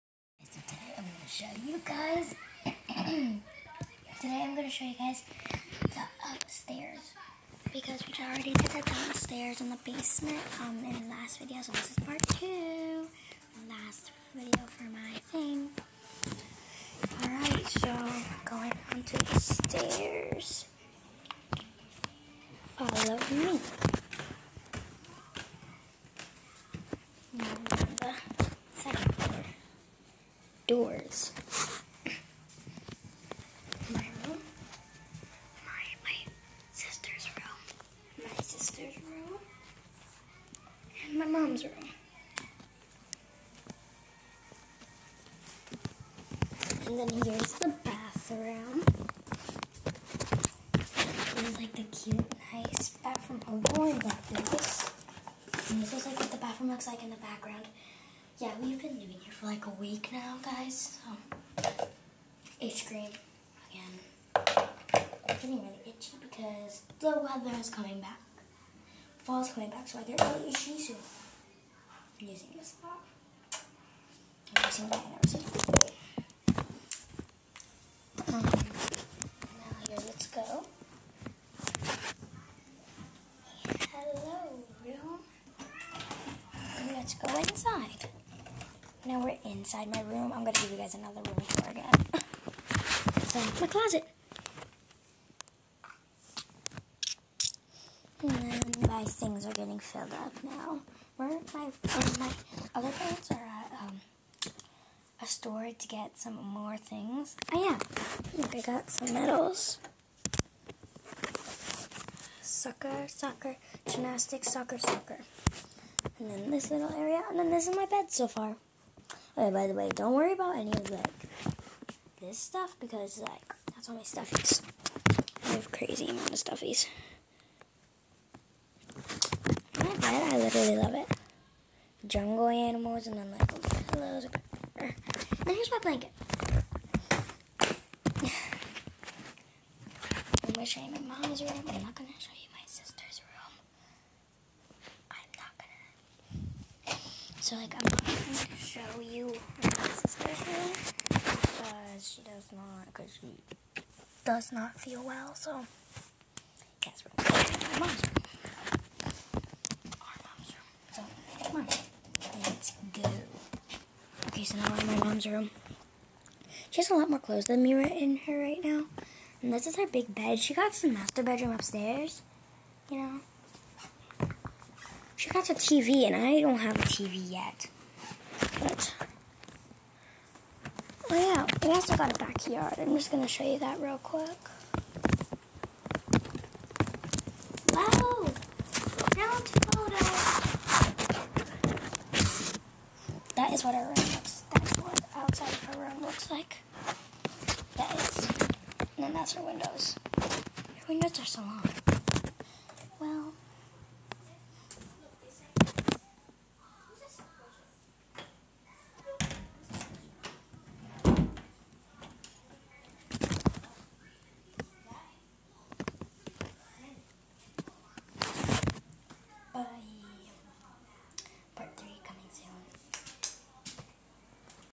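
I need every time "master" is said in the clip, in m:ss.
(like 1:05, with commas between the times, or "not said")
2:50.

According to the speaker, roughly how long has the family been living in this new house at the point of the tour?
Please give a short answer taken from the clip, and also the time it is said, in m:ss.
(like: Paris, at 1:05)
A week, at 0:59.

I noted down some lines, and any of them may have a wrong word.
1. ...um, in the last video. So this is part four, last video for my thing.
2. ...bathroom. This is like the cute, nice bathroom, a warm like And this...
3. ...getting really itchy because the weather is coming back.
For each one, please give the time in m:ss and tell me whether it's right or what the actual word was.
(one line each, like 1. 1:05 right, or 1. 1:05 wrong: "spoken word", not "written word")
1. 0:10 wrong: "two", not "four"
2. 0:47 right
3. 1:05 right.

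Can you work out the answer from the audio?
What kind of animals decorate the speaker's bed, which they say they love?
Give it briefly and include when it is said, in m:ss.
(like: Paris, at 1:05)
Jungle animals, at 2:12.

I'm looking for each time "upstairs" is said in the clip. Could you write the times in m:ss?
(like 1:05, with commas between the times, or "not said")
0:06, 2:51.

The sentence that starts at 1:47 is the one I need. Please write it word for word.
Oh yeah, Look, I got some medals.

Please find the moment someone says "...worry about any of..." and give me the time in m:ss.
2:00.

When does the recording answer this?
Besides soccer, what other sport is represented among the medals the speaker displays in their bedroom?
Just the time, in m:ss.
1:53.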